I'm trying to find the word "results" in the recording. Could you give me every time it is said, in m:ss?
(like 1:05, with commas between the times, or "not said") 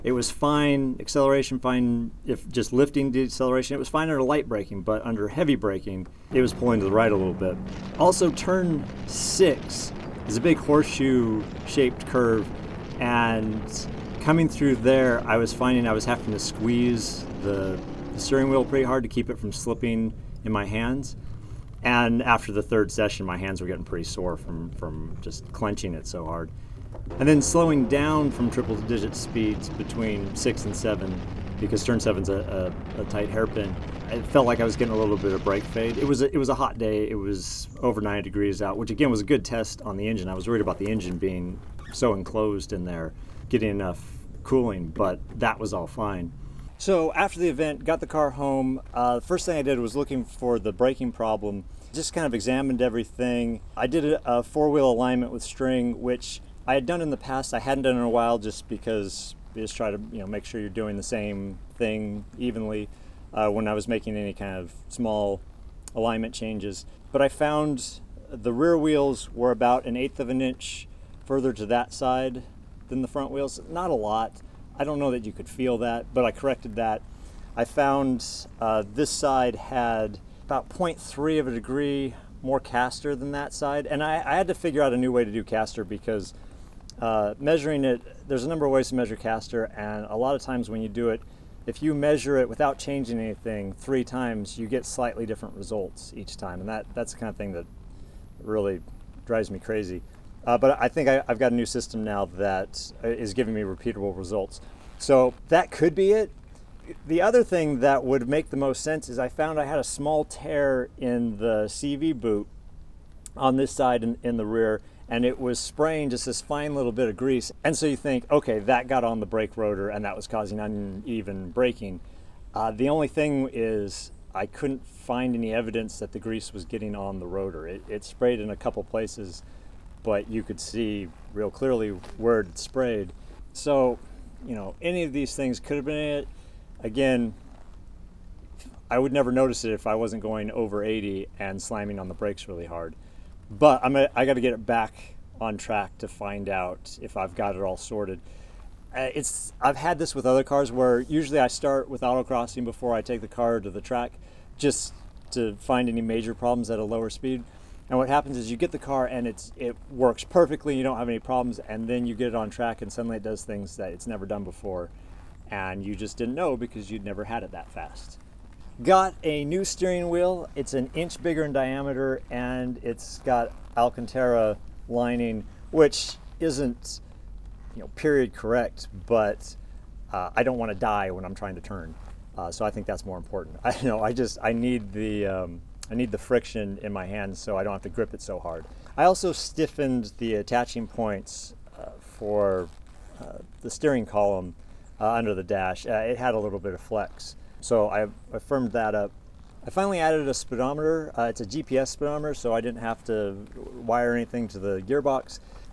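1:35, 1:44.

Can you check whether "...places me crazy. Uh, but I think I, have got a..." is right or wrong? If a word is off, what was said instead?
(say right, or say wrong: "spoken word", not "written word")
wrong: "drives", not "places".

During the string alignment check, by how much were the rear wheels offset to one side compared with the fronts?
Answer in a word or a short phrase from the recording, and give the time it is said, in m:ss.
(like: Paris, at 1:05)
1/8 inch, at 1:09.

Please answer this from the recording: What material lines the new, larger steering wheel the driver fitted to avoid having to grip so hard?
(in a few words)
Alcantara.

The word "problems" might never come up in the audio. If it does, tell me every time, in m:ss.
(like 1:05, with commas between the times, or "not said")
0:51, 2:36, 2:41.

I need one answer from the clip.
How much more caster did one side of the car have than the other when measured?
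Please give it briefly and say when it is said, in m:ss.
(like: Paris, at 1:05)
0.3 degree, at 1:20.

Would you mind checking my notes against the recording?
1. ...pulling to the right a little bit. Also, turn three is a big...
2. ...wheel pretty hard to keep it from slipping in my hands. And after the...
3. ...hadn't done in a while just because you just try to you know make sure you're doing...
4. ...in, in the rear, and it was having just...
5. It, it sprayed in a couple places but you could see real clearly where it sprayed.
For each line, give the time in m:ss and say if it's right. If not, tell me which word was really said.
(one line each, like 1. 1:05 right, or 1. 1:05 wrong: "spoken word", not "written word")
1. 0:06 wrong: "six", not "three"
2. 0:18 right
3. 0:57 right
4. 1:54 wrong: "spraying", not "having"
5. 2:07 right.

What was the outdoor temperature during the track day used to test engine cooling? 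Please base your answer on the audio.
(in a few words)
over 90 degrees.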